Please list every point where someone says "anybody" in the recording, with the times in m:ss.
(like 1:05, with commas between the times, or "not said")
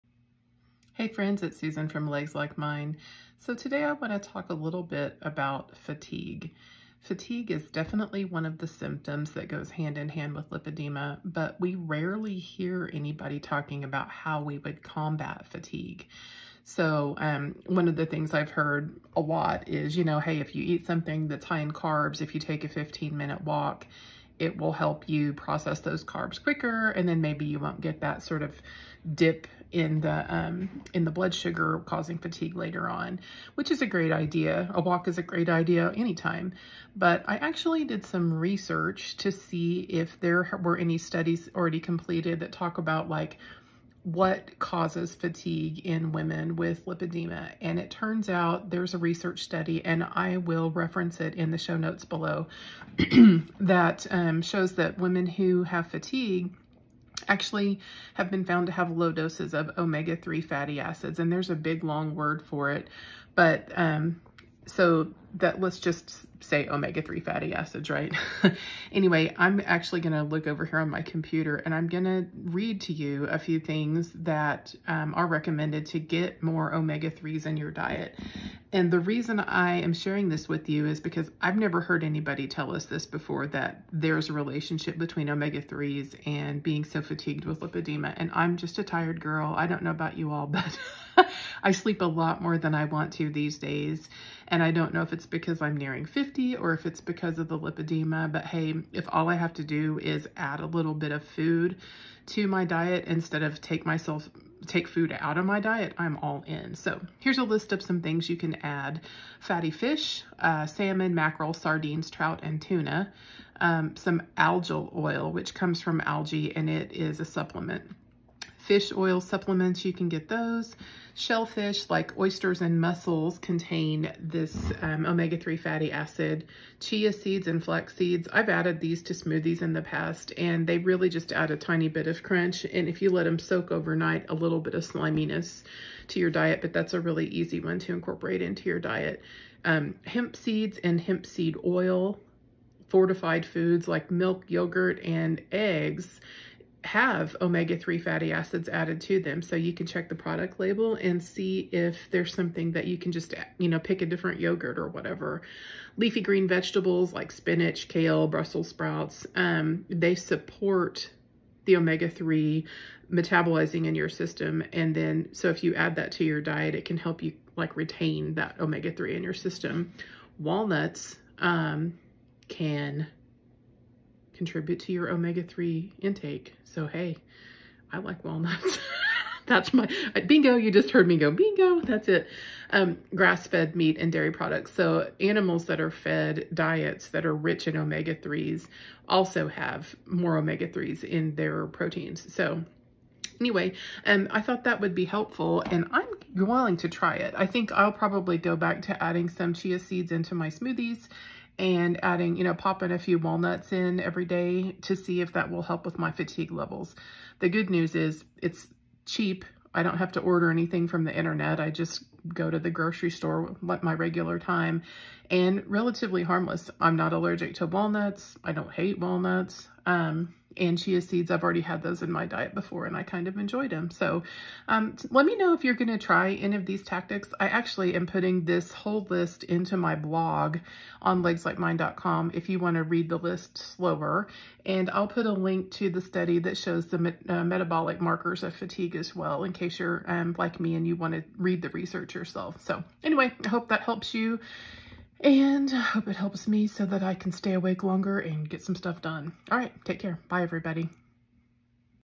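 0:12, 1:22.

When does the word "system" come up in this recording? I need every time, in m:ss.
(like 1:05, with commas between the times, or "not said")
2:44, 2:49.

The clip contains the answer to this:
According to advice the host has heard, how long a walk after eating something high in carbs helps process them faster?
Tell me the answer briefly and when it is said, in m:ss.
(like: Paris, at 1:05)
15 minutes, at 0:22.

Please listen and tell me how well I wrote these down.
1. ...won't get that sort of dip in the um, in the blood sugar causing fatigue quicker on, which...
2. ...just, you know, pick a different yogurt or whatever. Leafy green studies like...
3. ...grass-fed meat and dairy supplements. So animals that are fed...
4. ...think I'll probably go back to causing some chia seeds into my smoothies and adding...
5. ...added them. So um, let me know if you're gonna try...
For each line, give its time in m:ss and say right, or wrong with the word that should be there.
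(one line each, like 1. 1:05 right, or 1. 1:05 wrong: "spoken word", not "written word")
1. 0:27 wrong: "later", not "quicker"
2. 2:33 wrong: "vegetables", not "studies"
3. 3:03 wrong: "products", not "supplements"
4. 3:17 wrong: "adding", not "causing"
5. 3:43 wrong: "enjoyed", not "added".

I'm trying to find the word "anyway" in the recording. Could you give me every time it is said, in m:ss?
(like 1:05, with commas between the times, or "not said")
1:08, 3:13, 4:03.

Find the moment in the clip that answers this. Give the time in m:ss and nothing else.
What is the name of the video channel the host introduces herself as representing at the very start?
0:02.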